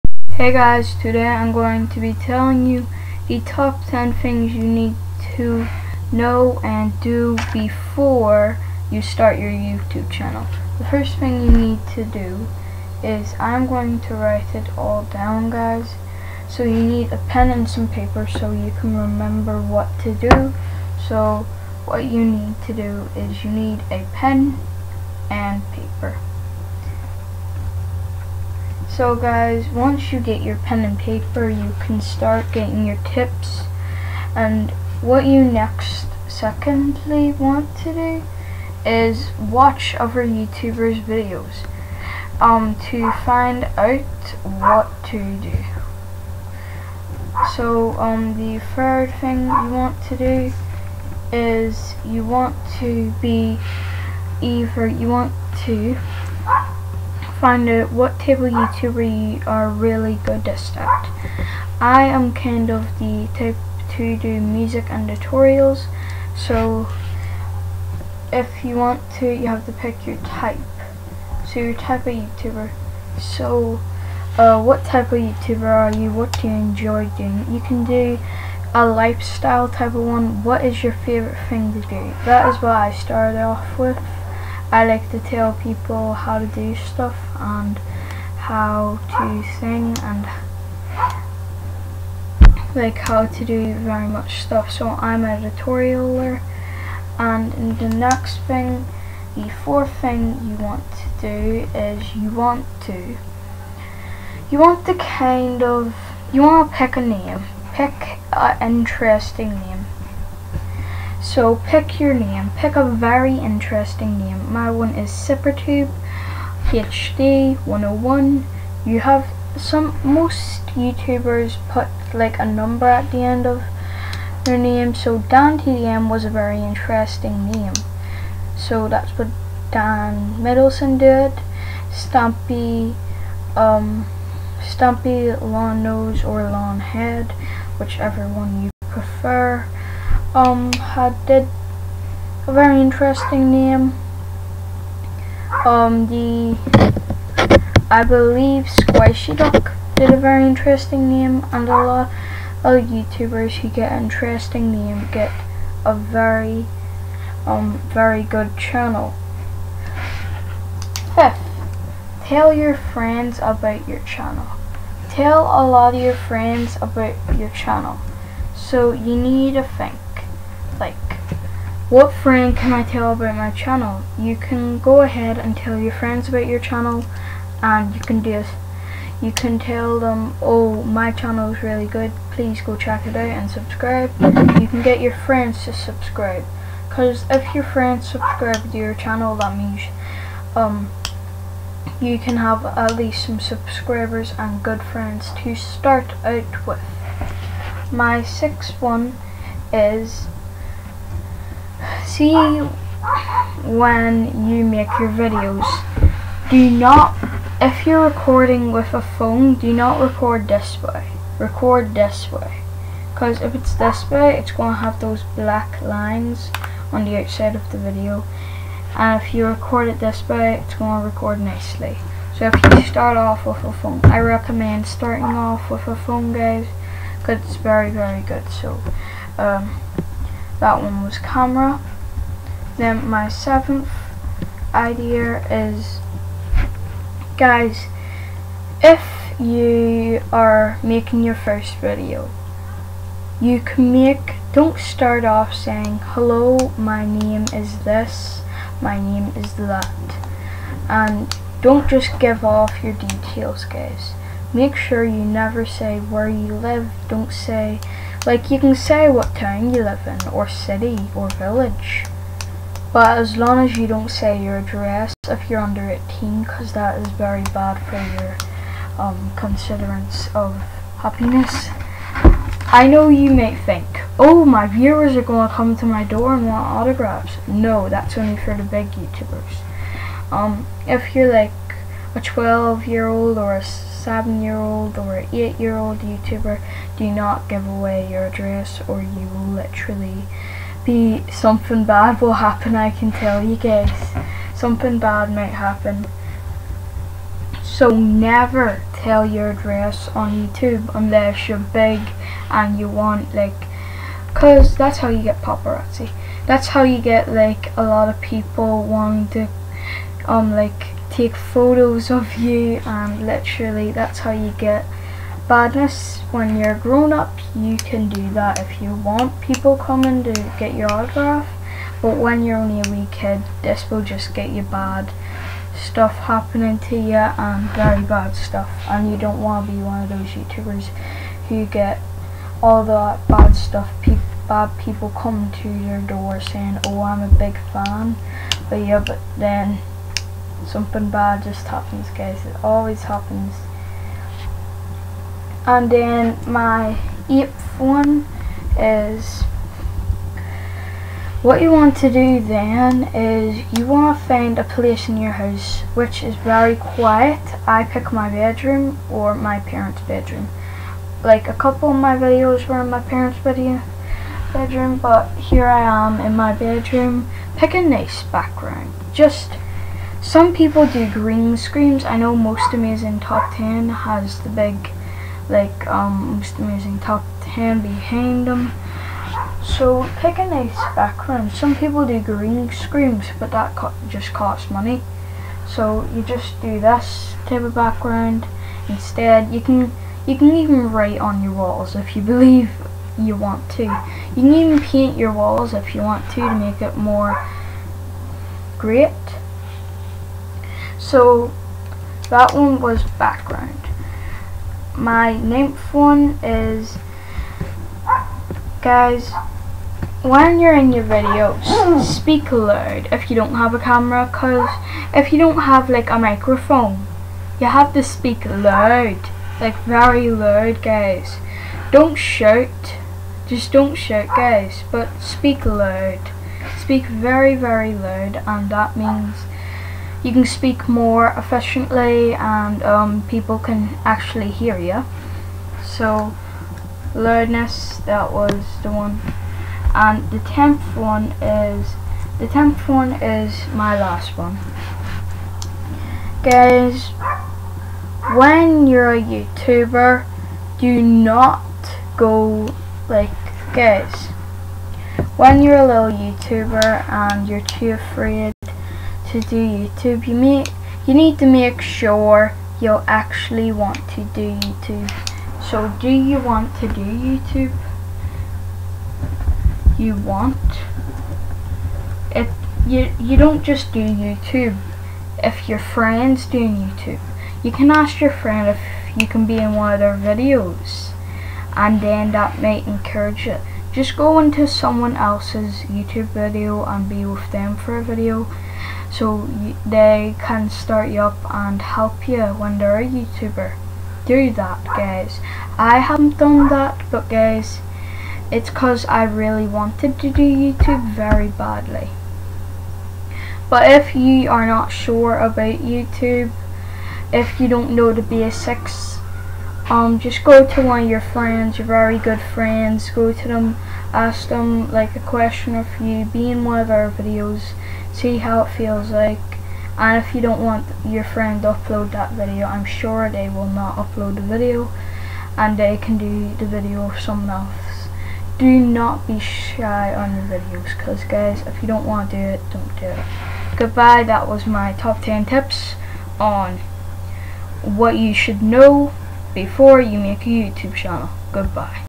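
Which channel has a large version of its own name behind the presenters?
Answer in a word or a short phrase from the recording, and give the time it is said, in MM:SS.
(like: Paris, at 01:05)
Most Amazing Top 10, at 06:12.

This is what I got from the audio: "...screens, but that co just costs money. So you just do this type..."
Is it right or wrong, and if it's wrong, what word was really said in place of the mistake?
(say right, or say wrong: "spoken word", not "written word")
right.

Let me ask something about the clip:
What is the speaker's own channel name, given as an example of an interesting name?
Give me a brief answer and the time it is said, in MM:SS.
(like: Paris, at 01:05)
SippierTube HD 101, at 01:55.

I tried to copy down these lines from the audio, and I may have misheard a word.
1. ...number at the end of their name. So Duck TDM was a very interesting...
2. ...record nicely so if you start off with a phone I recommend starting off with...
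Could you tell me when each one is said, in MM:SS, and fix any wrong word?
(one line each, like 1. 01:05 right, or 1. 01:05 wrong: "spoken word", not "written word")
1. 02:02 wrong: "Dan", not "Duck"
2. 03:41 right.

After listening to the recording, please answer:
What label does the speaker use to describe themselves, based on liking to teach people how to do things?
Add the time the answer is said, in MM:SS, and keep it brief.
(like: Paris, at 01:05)
Tutorialer, at 01:35.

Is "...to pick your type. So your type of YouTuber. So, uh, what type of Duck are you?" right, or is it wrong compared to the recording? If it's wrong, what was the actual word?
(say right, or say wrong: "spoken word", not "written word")
wrong: "YouTuber", not "Duck".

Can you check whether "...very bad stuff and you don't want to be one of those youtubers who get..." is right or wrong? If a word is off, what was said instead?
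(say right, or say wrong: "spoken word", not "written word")
right.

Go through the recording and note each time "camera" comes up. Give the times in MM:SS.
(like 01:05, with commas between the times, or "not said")
03:51, 06:53.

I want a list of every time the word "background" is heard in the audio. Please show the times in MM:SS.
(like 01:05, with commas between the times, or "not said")
06:08, 06:20, 06:27, 06:43.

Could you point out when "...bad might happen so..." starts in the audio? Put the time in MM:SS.
04:54.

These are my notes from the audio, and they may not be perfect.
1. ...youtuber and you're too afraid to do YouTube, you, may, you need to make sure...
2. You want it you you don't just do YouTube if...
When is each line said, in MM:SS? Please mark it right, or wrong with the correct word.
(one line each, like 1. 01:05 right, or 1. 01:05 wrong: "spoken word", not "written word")
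1. 07:36 right
2. 07:49 right.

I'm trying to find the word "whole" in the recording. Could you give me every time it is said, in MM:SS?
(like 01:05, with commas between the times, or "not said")
not said.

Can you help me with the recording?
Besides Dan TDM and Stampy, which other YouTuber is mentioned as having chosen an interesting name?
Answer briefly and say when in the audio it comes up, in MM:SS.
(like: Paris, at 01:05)
Squishy Duck, at 02:28.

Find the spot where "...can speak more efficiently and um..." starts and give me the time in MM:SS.
07:10.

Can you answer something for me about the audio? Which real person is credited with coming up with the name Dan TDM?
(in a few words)
Dan Middleton.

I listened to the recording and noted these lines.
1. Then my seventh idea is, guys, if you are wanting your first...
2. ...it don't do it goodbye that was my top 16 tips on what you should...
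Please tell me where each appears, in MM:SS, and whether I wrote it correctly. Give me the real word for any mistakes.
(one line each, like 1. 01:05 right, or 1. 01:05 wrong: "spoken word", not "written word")
1. 03:52 wrong: "making", not "wanting"
2. 08:52 wrong: "10", not "16".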